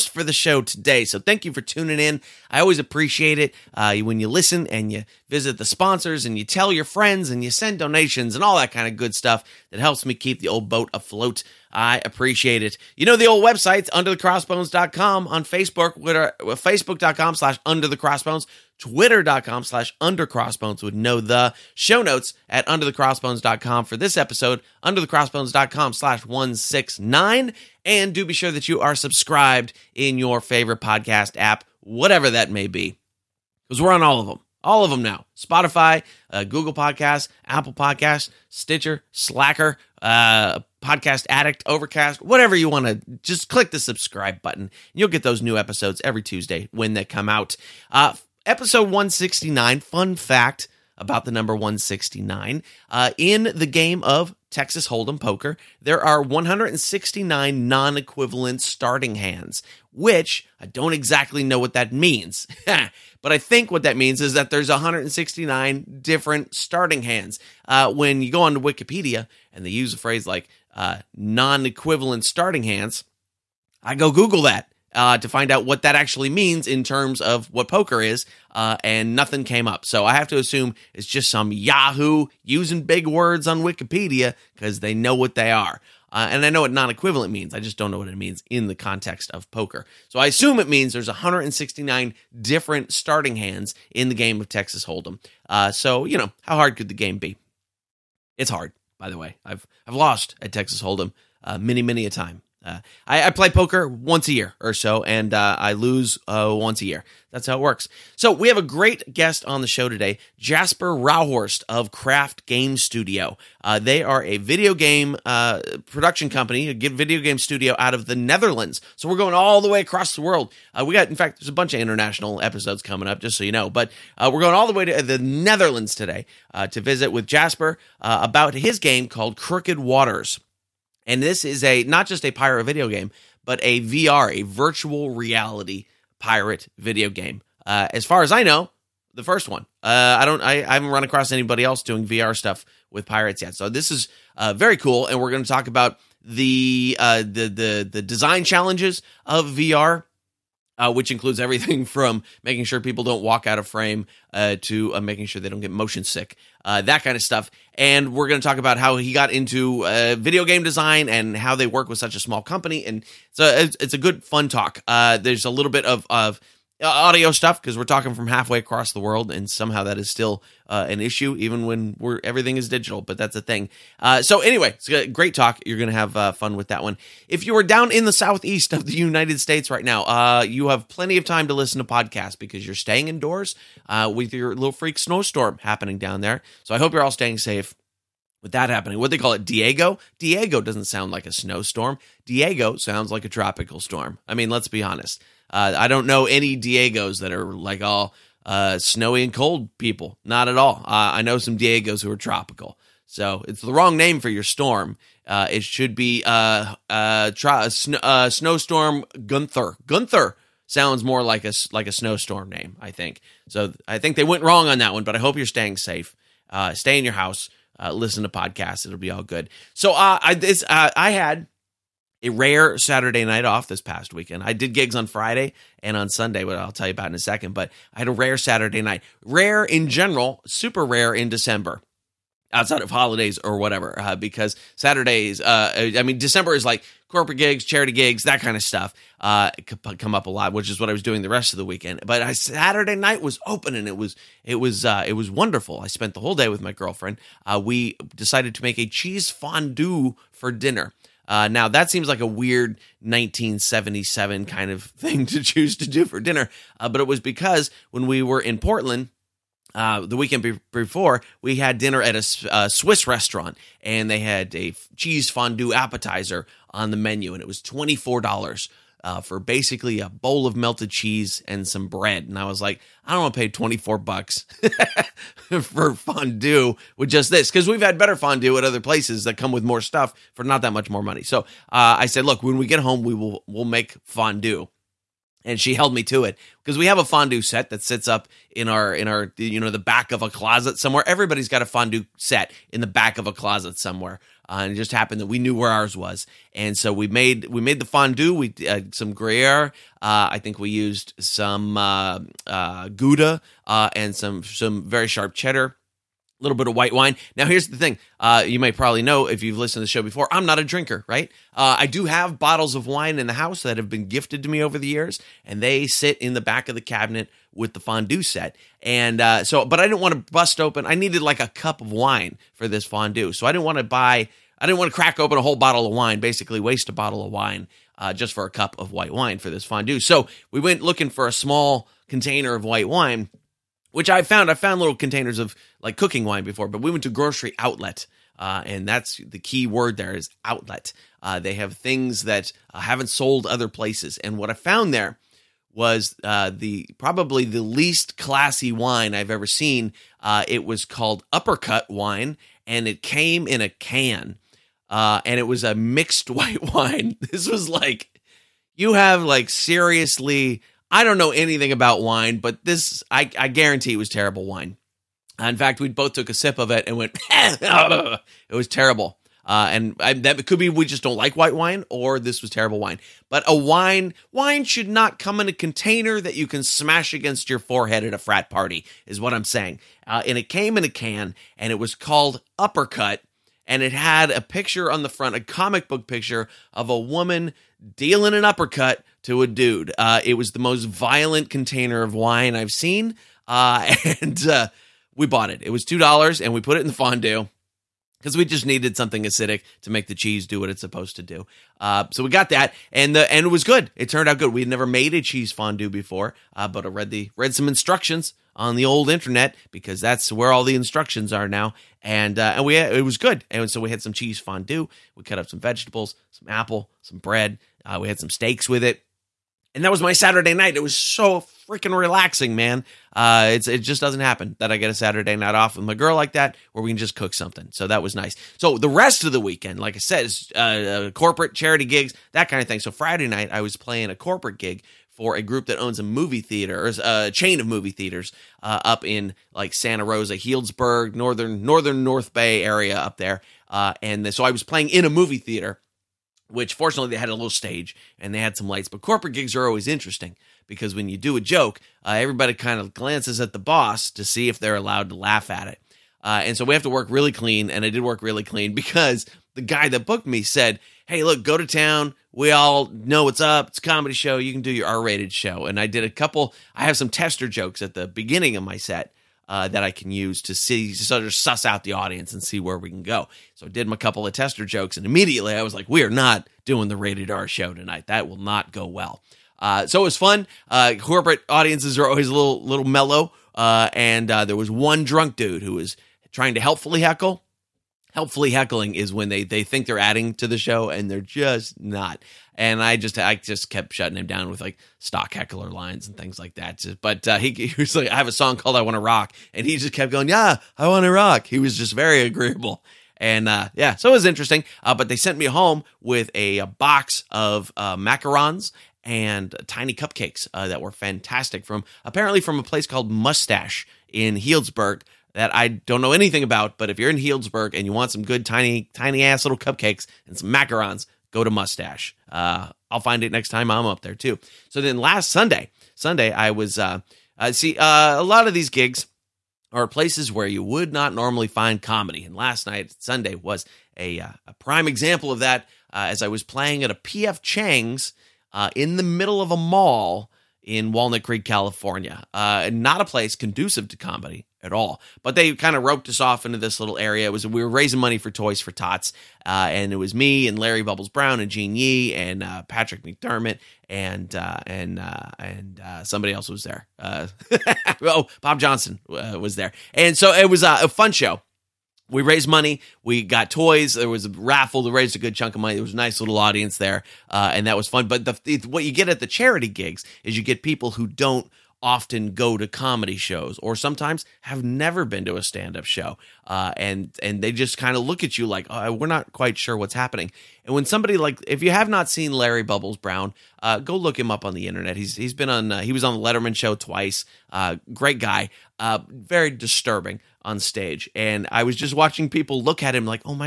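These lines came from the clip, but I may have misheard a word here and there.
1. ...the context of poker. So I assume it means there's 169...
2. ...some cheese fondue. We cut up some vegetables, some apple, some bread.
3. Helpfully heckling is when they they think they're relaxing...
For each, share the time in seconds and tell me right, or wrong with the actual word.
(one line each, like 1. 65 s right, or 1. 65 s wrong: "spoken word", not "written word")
1. 88 s right
2. 414 s right
3. 488 s wrong: "adding", not "relaxing".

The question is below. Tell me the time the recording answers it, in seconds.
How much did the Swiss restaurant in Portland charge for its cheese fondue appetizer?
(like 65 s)
267 s.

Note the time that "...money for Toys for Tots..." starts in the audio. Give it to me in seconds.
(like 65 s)
547 s.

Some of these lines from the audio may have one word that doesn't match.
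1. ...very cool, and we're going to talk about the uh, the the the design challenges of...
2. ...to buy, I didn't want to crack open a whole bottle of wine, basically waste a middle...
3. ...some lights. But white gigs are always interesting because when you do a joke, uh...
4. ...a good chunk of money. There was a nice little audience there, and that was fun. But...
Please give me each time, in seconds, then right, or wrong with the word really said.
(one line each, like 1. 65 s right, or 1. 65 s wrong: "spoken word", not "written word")
1. 144 s right
2. 323 s wrong: "bottle", not "middle"
3. 448 s wrong: "corporate", not "white"
4. 565 s right.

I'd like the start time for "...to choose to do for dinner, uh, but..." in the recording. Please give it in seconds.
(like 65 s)
255 s.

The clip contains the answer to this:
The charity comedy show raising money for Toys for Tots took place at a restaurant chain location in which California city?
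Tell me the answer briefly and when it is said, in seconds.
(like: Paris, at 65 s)
Walnut Creek, at 540 s.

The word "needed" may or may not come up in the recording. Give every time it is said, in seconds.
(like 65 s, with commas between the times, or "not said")
320 s, 398 s.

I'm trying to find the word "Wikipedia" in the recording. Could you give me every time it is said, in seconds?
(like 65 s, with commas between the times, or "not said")
68 s, 83 s.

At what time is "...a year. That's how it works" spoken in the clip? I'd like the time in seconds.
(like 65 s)
106 s.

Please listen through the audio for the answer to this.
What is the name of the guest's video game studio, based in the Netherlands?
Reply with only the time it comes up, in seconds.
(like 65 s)
111 s.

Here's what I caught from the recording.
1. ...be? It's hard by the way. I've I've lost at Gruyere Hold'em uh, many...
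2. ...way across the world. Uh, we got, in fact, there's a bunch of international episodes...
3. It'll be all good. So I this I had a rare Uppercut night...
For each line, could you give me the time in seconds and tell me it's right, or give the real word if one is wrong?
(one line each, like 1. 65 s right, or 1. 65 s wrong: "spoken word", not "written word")
1. 97 s wrong: "Texas", not "Gruyere"
2. 119 s right
3. 218 s wrong: "Saturday", not "Uppercut".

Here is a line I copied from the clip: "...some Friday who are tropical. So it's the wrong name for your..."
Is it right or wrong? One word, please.
wrong.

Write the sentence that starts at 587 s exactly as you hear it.
Uh, great guy, uh, very disturbing on stage.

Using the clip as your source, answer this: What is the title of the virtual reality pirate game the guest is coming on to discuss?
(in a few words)
Crooked Waters.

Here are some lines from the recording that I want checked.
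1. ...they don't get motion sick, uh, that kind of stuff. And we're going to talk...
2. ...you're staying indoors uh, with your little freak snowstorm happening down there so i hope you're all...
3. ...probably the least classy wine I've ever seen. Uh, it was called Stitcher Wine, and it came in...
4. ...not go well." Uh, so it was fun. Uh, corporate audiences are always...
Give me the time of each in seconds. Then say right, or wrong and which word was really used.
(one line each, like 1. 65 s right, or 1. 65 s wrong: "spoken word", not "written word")
1. 155 s right
2. 182 s right
3. 346 s wrong: "Uppercut", not "Stitcher"
4. 478 s right.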